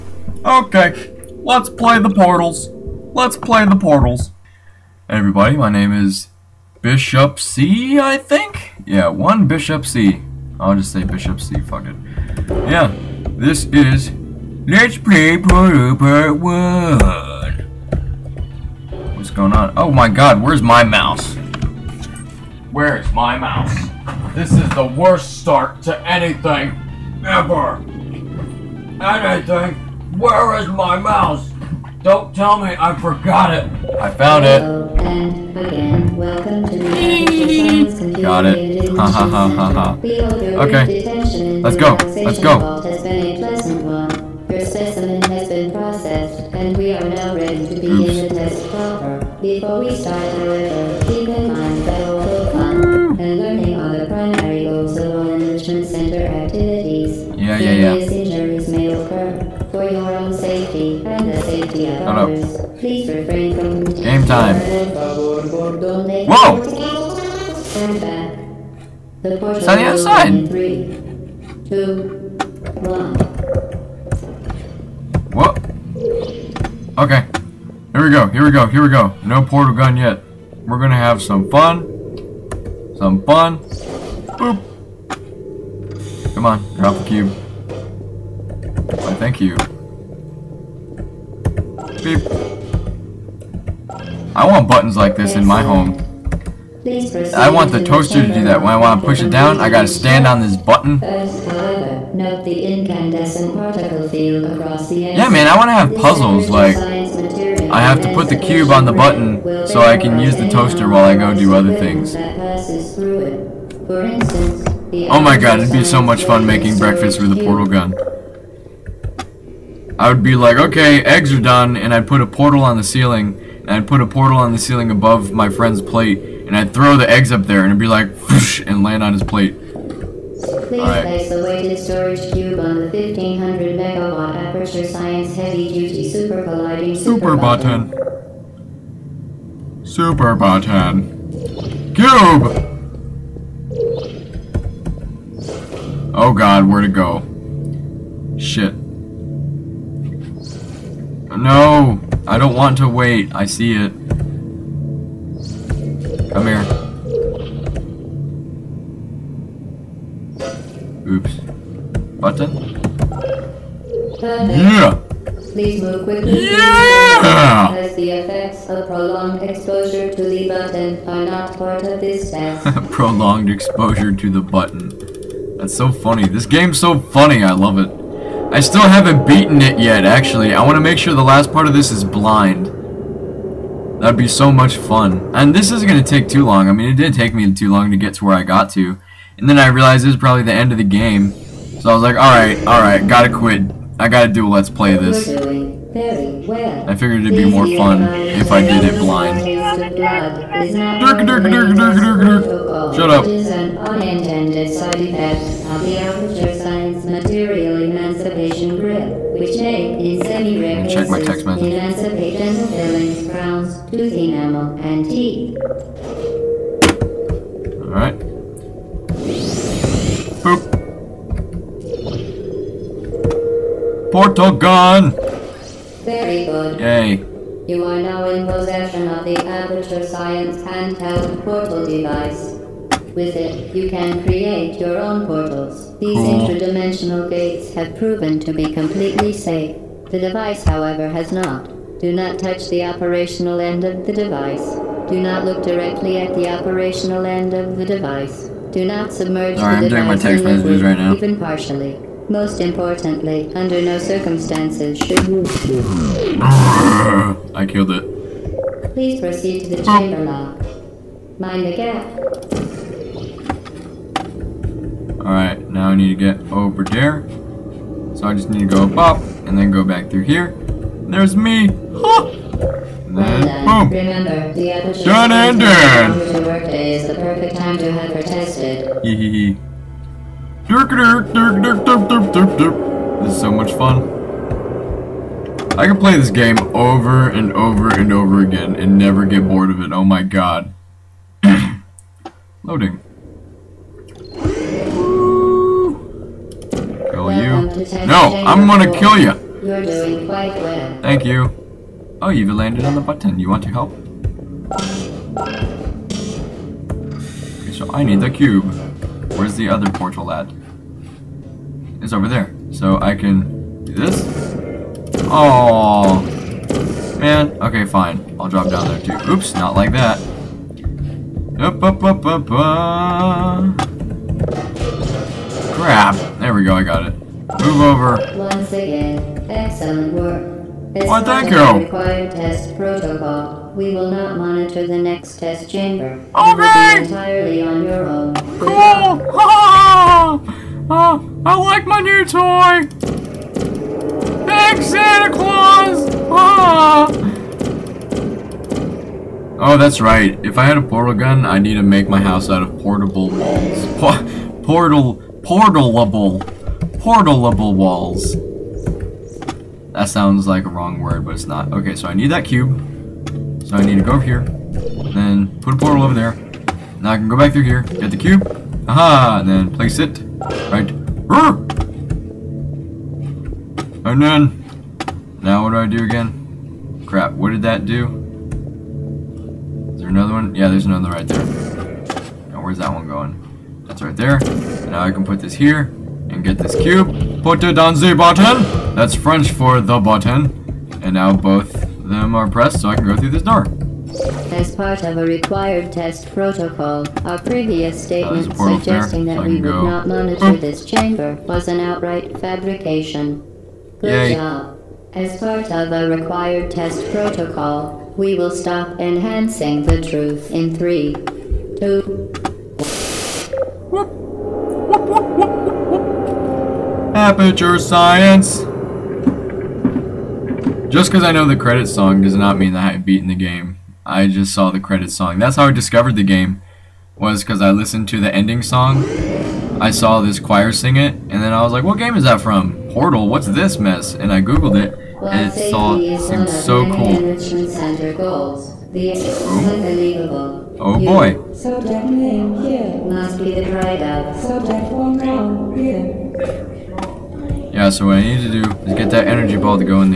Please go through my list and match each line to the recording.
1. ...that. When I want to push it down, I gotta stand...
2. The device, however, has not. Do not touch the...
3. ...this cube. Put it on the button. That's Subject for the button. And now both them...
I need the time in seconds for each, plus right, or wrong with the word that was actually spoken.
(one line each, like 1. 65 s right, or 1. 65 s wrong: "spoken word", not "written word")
1. 98 s right
2. 240 s right
3. 386 s wrong: "French", not "Subject".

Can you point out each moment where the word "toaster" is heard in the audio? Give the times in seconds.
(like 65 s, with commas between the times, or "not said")
97 s, 110 s.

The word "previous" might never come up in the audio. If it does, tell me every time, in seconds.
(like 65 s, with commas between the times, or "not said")
397 s.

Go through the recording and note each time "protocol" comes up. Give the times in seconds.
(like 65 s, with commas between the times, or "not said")
332 s, 396 s, 407 s.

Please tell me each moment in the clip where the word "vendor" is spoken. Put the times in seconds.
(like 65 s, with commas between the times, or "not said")
not said.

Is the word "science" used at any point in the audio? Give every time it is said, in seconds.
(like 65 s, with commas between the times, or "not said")
134 s, 206 s, 230 s, 417 s.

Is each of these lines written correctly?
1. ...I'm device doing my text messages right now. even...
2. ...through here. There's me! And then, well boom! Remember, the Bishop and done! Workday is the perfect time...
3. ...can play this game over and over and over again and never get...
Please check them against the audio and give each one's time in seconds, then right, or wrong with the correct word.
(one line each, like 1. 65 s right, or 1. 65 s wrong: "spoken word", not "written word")
1. 249 s right
2. 270 s wrong: "Done", not "Bishop"
3. 285 s right.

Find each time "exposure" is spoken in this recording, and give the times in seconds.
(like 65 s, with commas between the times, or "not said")
169 s, 173 s.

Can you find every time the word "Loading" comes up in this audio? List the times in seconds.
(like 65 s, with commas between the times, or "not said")
292 s.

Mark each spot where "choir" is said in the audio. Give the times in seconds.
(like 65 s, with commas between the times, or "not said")
430 s.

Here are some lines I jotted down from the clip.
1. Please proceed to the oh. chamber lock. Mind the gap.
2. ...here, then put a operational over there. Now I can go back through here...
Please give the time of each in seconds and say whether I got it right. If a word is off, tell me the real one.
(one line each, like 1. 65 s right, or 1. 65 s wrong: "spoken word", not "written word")
1. 258 s right
2. 364 s wrong: "portal", not "operational".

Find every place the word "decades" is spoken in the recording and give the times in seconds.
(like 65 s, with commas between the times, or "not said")
not said.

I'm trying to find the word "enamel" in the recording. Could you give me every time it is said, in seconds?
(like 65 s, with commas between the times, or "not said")
214 s.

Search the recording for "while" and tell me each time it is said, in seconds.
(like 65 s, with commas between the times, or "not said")
110 s.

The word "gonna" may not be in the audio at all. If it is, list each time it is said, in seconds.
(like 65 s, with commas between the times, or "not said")
80 s, 298 s.